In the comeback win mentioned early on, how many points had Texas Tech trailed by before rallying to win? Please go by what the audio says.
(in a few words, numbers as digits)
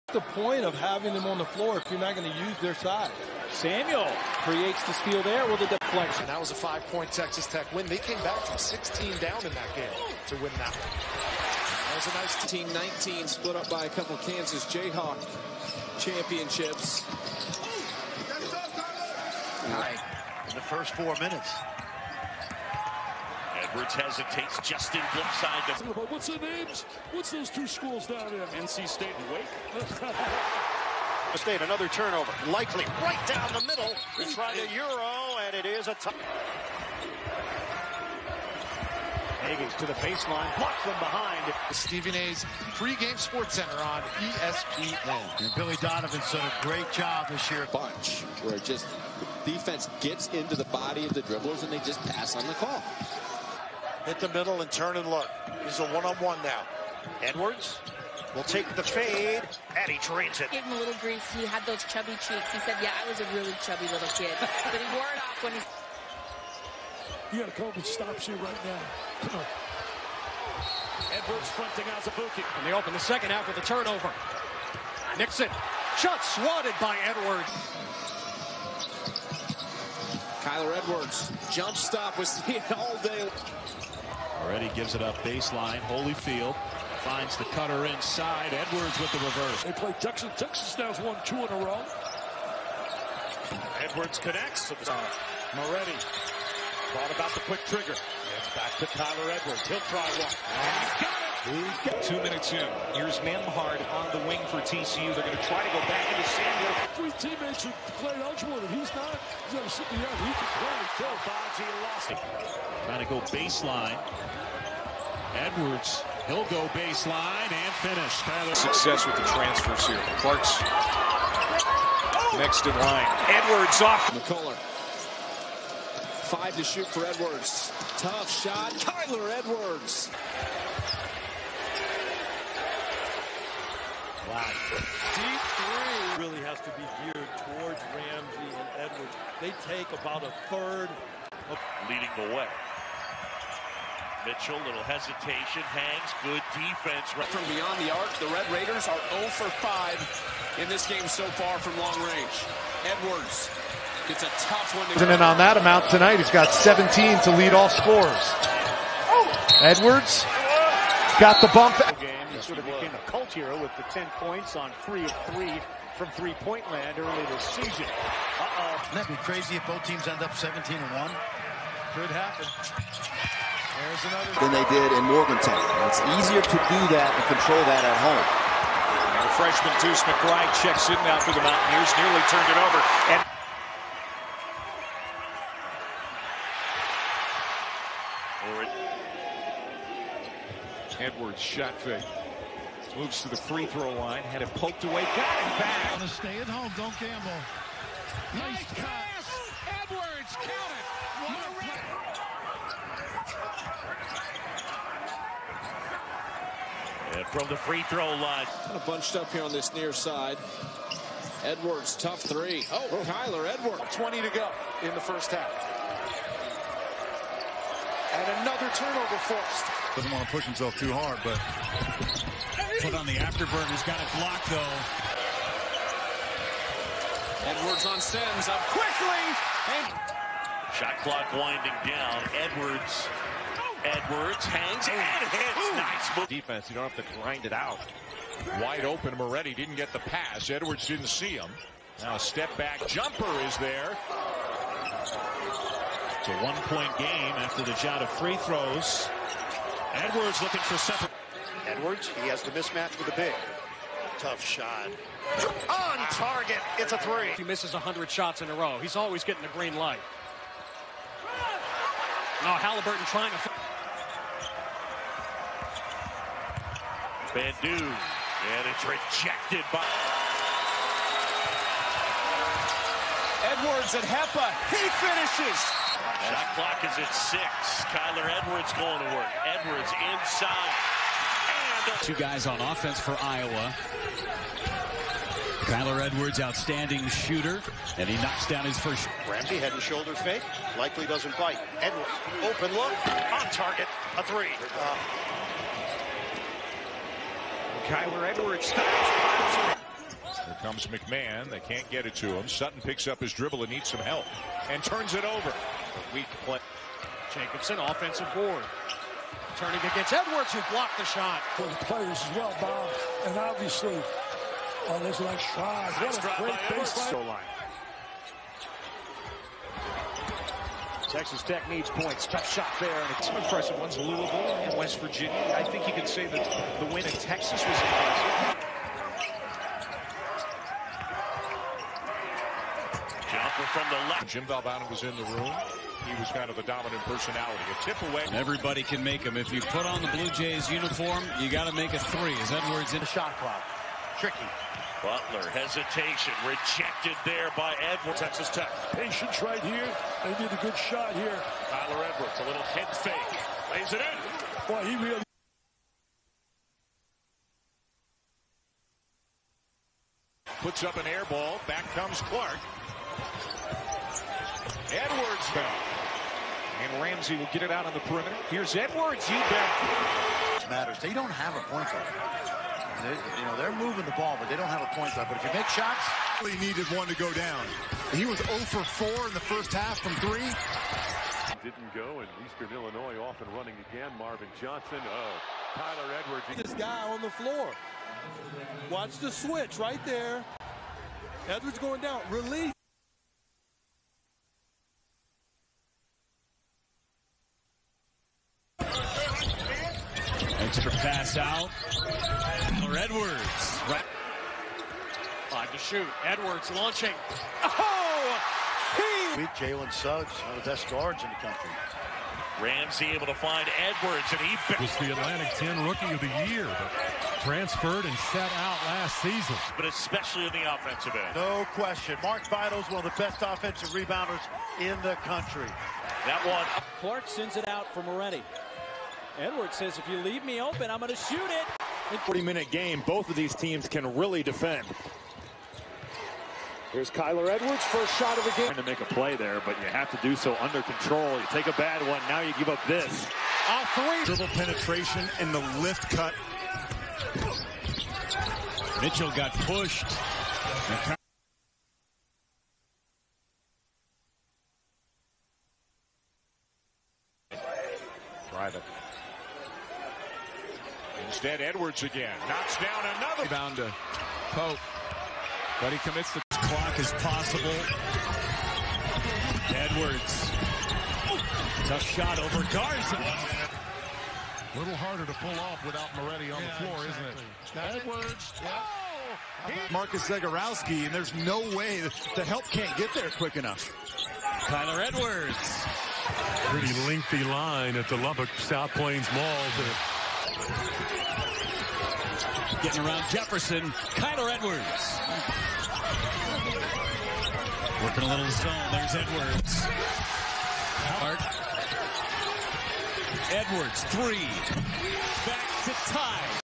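16.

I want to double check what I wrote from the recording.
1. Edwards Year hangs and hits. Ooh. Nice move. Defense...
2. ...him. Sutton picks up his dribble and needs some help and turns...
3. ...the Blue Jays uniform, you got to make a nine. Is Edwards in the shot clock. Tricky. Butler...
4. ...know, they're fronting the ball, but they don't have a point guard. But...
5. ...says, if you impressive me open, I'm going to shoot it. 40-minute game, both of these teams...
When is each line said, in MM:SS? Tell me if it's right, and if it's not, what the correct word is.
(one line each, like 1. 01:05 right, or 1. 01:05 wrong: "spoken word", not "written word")
1. 03:52 wrong: "Edwards", not "Year"
2. 05:02 right
3. 05:40 wrong: "three", not "nine"
4. 06:13 wrong: "moving", not "fronting"
5. 07:09 wrong: "leave", not "impressive".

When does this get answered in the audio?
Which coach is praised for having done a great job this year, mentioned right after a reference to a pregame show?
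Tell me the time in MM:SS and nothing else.
00:45.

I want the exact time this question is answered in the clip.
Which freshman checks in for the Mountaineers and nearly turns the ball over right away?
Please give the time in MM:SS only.
02:59.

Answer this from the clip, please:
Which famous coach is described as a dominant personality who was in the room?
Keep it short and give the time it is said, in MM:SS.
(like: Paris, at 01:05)
Jim Valvano, at 05:34.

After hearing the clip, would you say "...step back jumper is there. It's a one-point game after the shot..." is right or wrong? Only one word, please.
right.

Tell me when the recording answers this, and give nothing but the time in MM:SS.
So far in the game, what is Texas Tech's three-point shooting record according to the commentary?
02:29.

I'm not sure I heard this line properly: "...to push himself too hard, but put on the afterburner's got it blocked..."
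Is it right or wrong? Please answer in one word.
right.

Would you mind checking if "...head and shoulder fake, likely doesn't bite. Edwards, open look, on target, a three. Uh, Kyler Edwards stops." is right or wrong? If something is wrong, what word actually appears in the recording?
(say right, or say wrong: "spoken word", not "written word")
right.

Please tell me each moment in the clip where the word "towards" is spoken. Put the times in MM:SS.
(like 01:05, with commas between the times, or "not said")
02:17.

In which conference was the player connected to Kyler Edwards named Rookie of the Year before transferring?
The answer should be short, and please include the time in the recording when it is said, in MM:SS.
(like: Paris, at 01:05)
Atlantic 10, at 06:55.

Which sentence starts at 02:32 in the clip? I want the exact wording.
Edwards gets a tough one to And on that amount tonight, he's got 17 to lead all scorers.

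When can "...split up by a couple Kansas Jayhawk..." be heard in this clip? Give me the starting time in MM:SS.
00:13.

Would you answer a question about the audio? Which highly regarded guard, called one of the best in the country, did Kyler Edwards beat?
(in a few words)
Jalen Suggs.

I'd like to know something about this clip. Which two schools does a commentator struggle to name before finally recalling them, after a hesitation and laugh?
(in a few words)
NC State and Wake.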